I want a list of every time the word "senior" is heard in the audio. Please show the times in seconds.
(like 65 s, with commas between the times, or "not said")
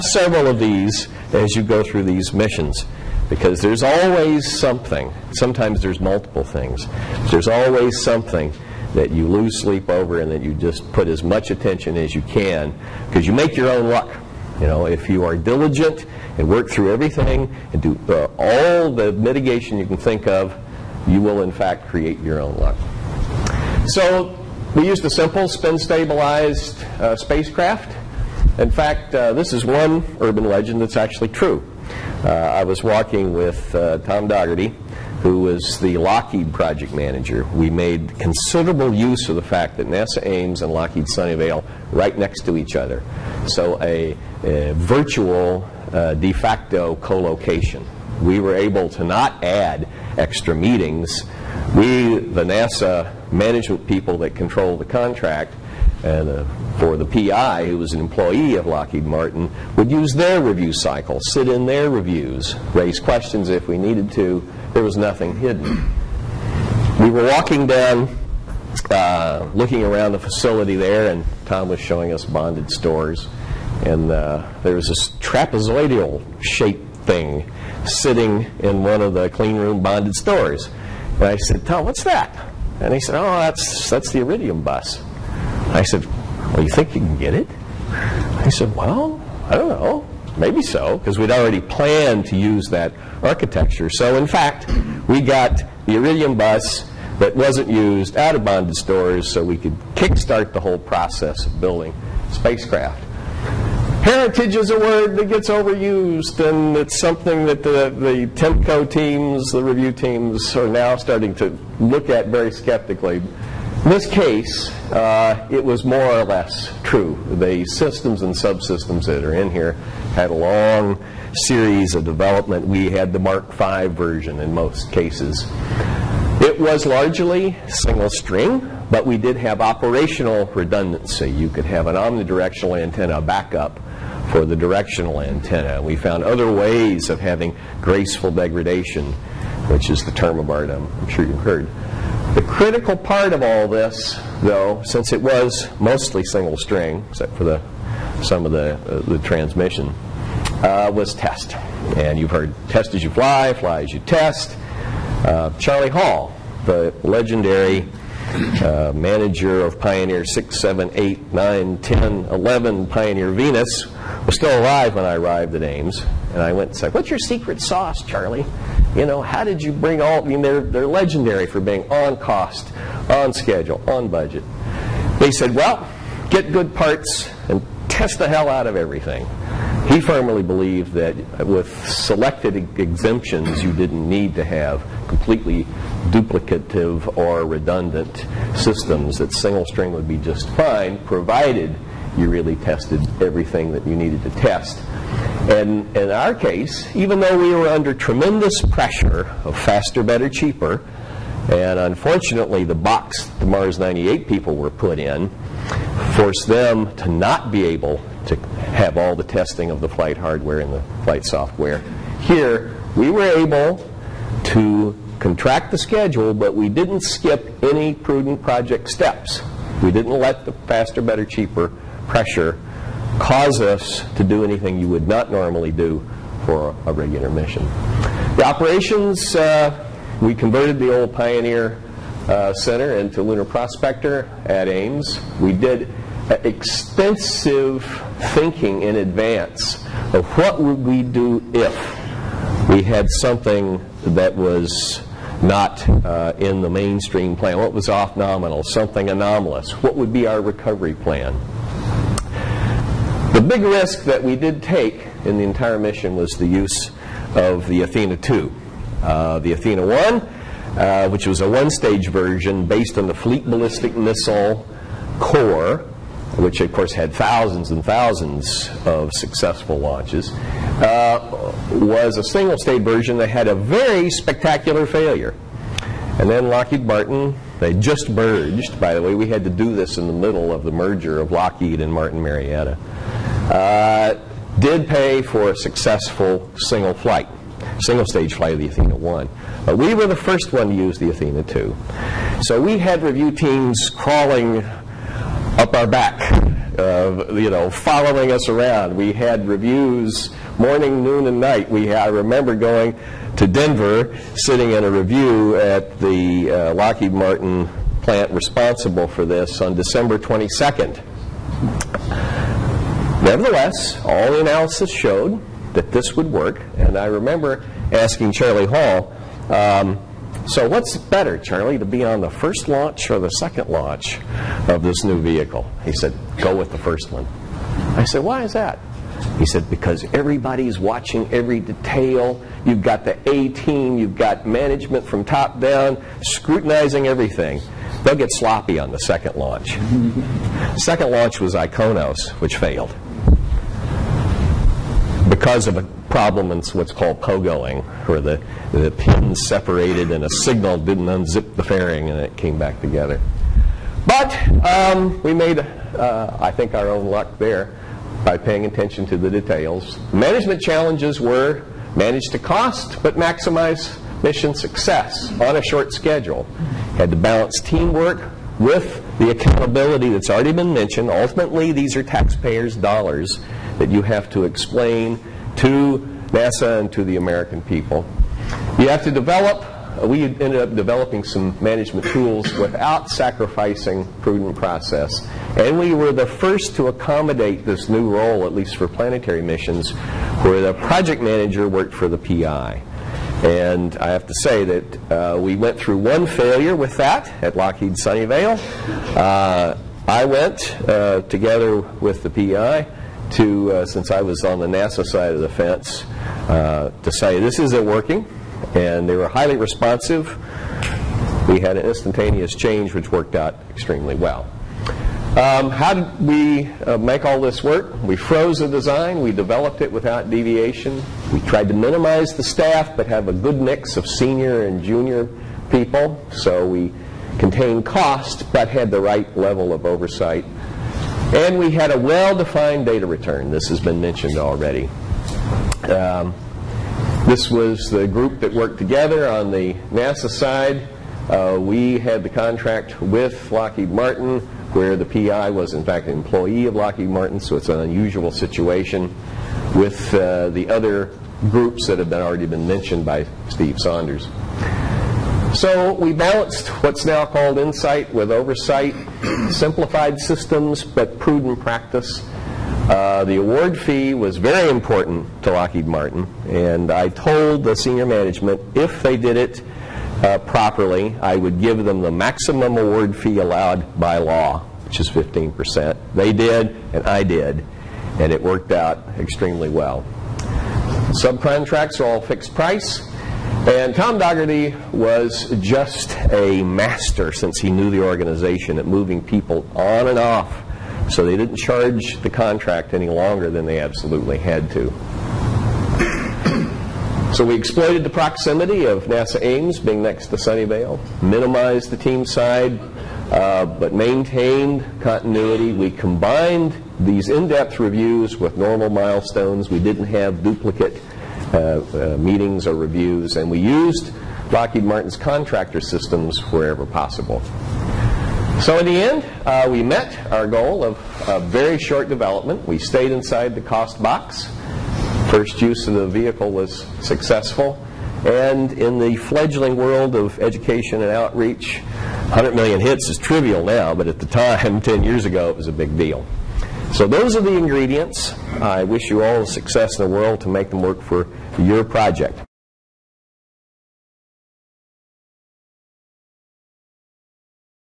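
424 s, 467 s.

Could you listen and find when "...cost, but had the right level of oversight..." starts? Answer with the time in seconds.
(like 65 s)
427 s.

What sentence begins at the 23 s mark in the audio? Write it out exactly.
So we used a simple spin stabilized uh, spacecraft.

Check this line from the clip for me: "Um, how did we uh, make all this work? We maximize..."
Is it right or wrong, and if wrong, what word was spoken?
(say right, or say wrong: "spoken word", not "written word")
wrong: "froze", not "maximize".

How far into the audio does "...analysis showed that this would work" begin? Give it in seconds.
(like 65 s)
314 s.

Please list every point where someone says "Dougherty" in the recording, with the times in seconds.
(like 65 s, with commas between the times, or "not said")
34 s, 484 s.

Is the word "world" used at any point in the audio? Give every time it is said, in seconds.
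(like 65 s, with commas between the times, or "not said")
529 s, 540 s.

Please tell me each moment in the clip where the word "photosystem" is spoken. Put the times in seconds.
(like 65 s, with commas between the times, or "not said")
not said.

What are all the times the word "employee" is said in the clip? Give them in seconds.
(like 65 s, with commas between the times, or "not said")
58 s, 446 s.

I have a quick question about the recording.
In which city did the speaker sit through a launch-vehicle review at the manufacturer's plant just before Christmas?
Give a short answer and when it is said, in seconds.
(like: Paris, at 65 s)
Denver, at 303 s.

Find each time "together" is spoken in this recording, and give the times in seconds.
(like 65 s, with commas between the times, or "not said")
352 s, 401 s, 438 s.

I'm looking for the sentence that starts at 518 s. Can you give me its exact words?
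So in the end, uh, we met our goal of a very short development.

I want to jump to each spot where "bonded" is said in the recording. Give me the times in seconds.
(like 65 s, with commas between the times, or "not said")
72 s, 79 s, 98 s.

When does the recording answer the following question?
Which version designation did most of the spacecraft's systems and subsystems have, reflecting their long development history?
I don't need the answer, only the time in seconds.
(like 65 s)
123 s.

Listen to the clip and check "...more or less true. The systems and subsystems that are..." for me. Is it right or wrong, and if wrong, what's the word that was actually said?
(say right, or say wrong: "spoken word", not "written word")
right.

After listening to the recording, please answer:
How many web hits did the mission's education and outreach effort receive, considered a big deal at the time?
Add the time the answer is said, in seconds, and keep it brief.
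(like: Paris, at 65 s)
100 million, at 532 s.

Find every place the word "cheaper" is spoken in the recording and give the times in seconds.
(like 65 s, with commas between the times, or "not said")
200 s, 221 s.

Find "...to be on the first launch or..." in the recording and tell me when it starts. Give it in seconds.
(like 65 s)
321 s.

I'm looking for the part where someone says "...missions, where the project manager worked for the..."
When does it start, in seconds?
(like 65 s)
389 s.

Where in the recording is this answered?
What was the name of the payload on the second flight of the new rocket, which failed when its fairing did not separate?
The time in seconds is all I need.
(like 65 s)
341 s.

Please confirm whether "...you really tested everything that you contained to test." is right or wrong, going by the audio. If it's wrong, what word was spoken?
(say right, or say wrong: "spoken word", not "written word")
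wrong: "needed", not "contained".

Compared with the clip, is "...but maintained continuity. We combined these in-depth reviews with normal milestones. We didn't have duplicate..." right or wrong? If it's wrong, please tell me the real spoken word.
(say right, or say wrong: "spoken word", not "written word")
right.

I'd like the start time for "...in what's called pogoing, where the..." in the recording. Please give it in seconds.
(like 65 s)
346 s.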